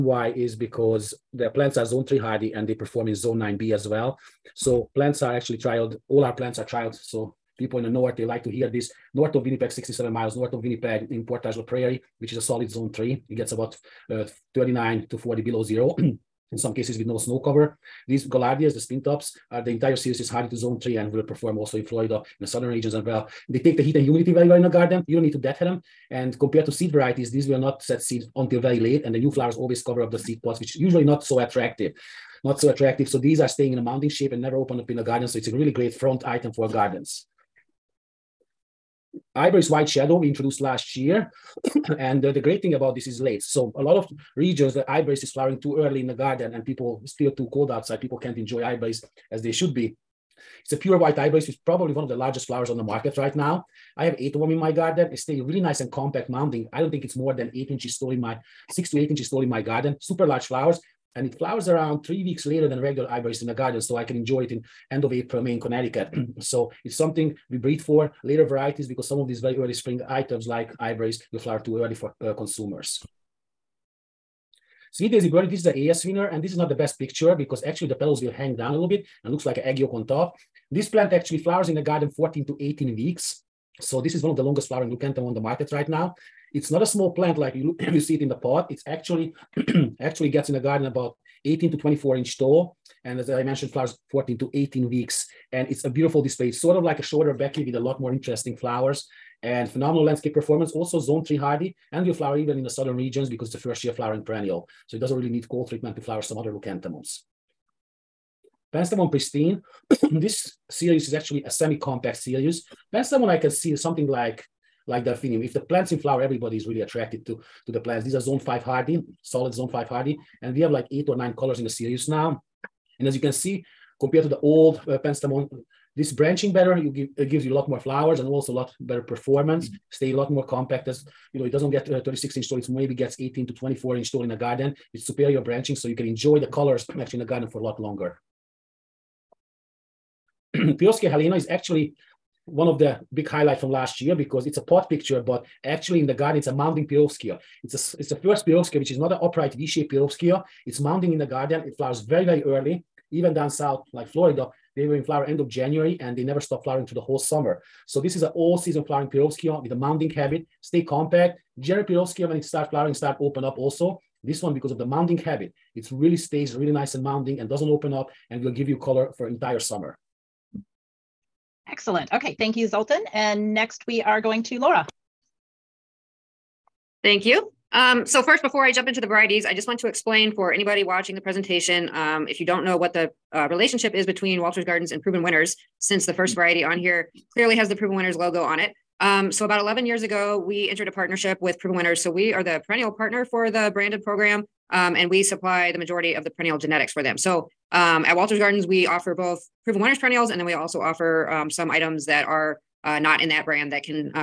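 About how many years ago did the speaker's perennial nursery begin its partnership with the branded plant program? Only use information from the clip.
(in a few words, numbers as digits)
11 years.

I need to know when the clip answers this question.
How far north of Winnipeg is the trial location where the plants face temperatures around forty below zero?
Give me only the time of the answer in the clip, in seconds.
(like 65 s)
9 s.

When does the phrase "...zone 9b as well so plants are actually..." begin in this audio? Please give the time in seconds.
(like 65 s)
3 s.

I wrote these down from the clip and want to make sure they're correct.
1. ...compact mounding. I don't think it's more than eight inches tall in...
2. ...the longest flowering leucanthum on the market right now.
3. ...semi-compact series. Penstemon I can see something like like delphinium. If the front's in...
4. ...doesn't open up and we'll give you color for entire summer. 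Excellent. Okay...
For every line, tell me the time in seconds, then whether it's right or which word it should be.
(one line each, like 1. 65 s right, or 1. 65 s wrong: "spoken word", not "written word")
1. 55 s right
2. 84 s right
3. 111 s wrong: "plant", not "front"
4. 167 s right.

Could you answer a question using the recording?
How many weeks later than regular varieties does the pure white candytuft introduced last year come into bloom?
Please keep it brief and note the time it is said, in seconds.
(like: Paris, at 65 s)
3 weeks, at 62 s.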